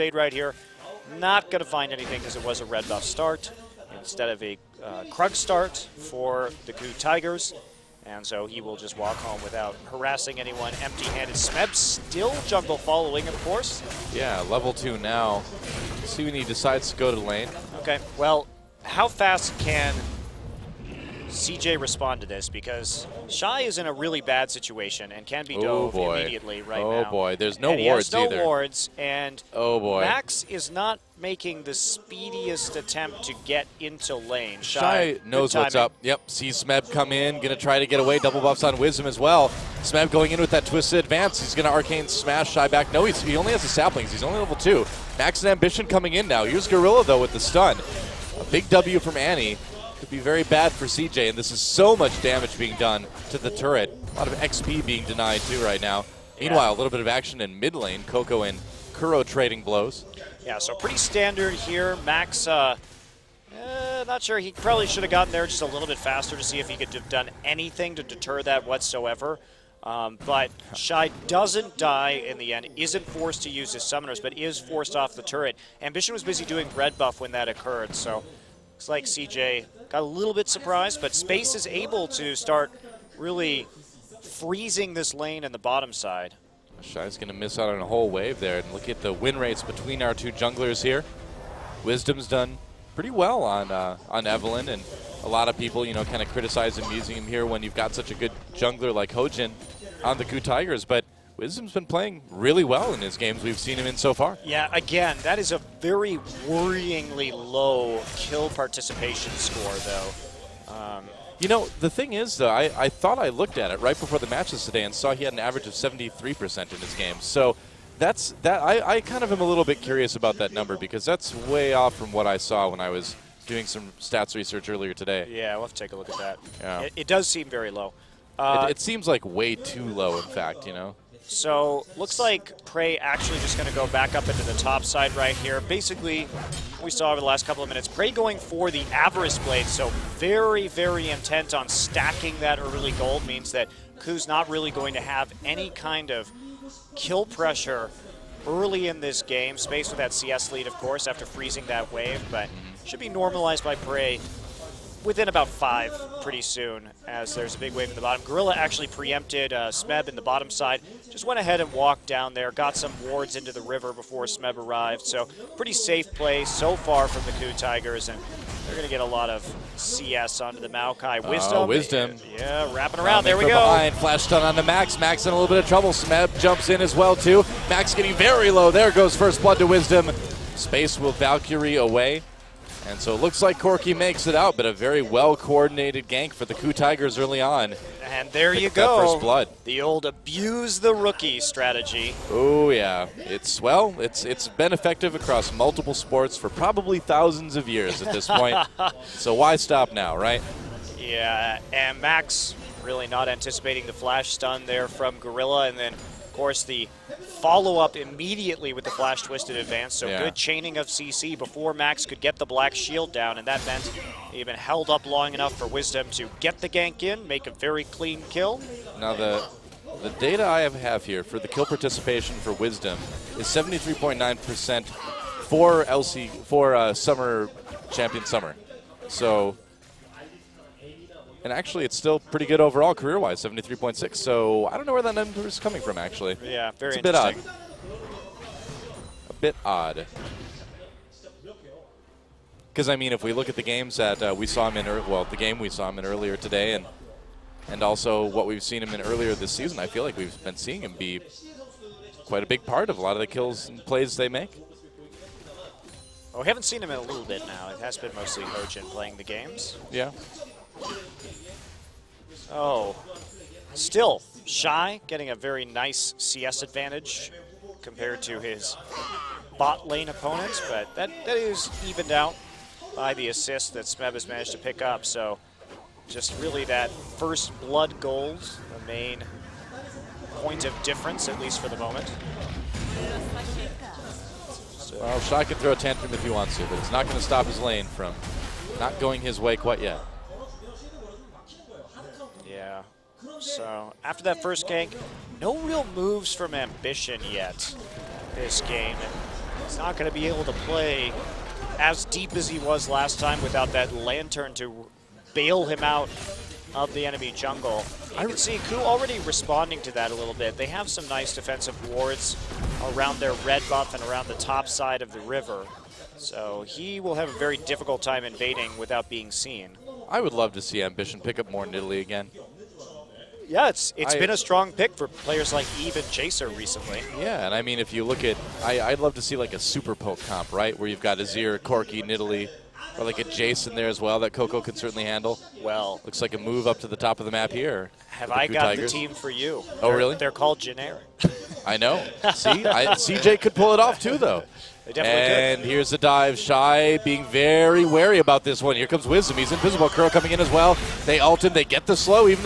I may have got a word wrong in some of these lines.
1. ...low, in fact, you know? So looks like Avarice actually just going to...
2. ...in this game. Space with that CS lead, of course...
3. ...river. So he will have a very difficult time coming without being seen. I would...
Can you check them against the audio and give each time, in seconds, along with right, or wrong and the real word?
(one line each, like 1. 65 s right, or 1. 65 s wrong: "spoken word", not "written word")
1. 129 s wrong: "PraY", not "Avarice"
2. 148 s right
3. 315 s wrong: "invading", not "coming".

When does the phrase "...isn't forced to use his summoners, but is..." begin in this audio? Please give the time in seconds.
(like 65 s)
72 s.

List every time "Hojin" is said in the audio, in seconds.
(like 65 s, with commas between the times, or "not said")
99 s, 258 s.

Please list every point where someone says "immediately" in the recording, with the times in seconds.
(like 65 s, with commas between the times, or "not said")
26 s, 207 s.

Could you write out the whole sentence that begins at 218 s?
Now the the data I have here for the kill participation for Wisdom is 73.9% for LC for uh, Summer Champion Summer.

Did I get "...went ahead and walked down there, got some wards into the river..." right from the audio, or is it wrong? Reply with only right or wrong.
right.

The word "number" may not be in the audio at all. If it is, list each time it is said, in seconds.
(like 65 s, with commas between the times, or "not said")
120 s, 235 s.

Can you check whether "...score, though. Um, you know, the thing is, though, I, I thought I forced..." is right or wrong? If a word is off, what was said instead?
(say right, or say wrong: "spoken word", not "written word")
wrong: "looked", not "forced".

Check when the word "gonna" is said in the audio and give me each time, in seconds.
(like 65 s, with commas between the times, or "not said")
37 s, 41 s.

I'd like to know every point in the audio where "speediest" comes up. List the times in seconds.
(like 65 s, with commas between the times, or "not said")
31 s.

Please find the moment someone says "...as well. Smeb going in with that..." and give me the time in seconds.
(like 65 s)
39 s.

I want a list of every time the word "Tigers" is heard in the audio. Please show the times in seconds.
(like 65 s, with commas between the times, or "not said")
6 s, 100 s, 167 s, 186 s, 338 s.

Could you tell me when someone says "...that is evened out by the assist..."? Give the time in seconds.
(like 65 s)
271 s.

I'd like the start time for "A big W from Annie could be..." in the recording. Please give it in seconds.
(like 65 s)
48 s.